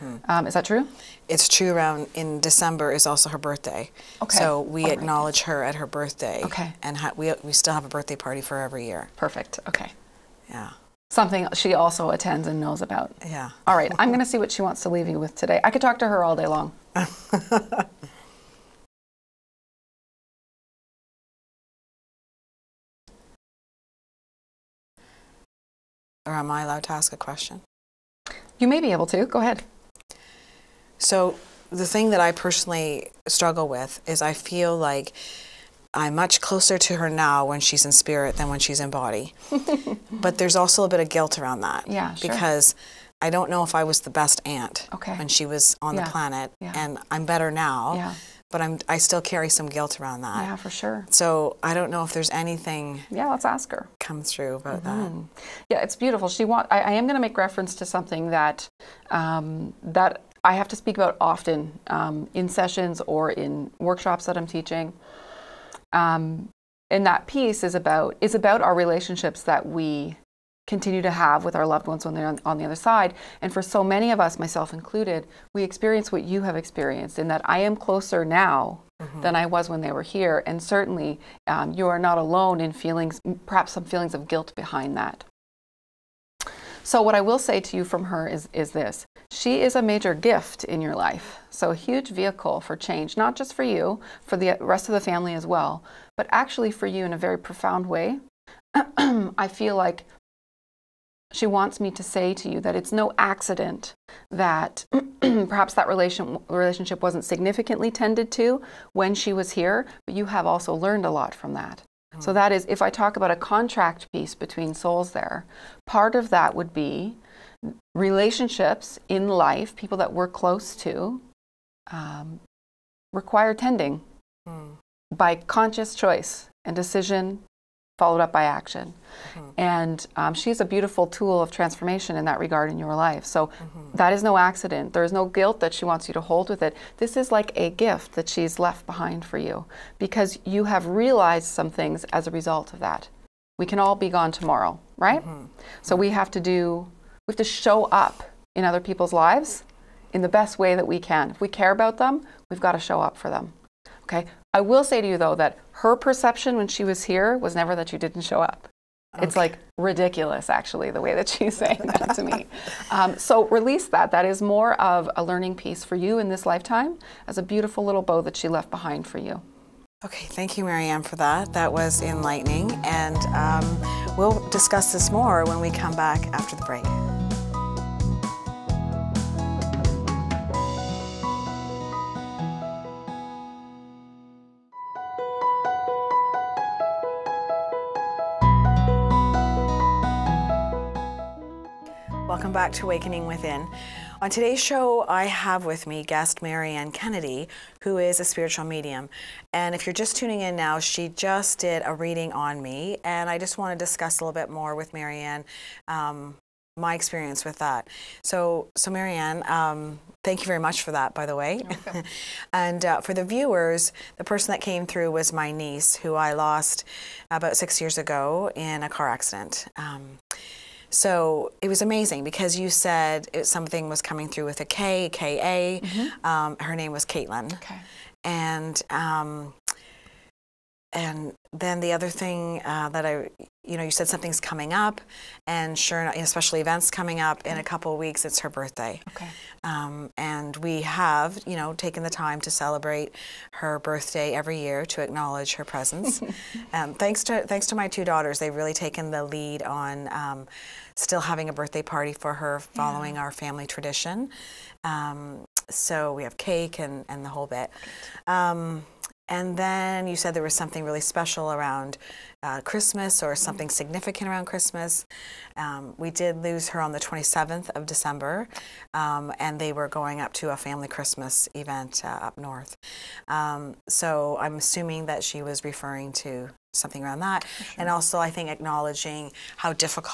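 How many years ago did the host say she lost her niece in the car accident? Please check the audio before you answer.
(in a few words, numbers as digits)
6.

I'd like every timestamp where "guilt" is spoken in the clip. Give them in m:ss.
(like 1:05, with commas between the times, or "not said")
0:41, 0:49, 1:24, 2:15.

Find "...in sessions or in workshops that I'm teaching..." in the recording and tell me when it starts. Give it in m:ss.
1:02.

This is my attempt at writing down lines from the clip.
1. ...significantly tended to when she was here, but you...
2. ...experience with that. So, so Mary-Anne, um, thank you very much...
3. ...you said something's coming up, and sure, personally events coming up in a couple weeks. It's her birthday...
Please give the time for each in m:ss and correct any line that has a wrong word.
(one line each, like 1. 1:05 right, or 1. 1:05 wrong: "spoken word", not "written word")
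1. 1:47 right
2. 3:26 right
3. 3:53 wrong: "especially", not "personally".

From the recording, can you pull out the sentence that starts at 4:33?
Um, so I'm assuming that she was referring to something around that.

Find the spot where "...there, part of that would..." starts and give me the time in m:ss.
1:55.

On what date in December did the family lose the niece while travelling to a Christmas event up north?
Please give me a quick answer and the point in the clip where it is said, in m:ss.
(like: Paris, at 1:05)
27th of December, at 4:26.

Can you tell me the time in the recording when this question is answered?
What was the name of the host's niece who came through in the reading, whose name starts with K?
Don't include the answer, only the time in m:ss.
3:47.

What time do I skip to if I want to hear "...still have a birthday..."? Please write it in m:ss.
0:07.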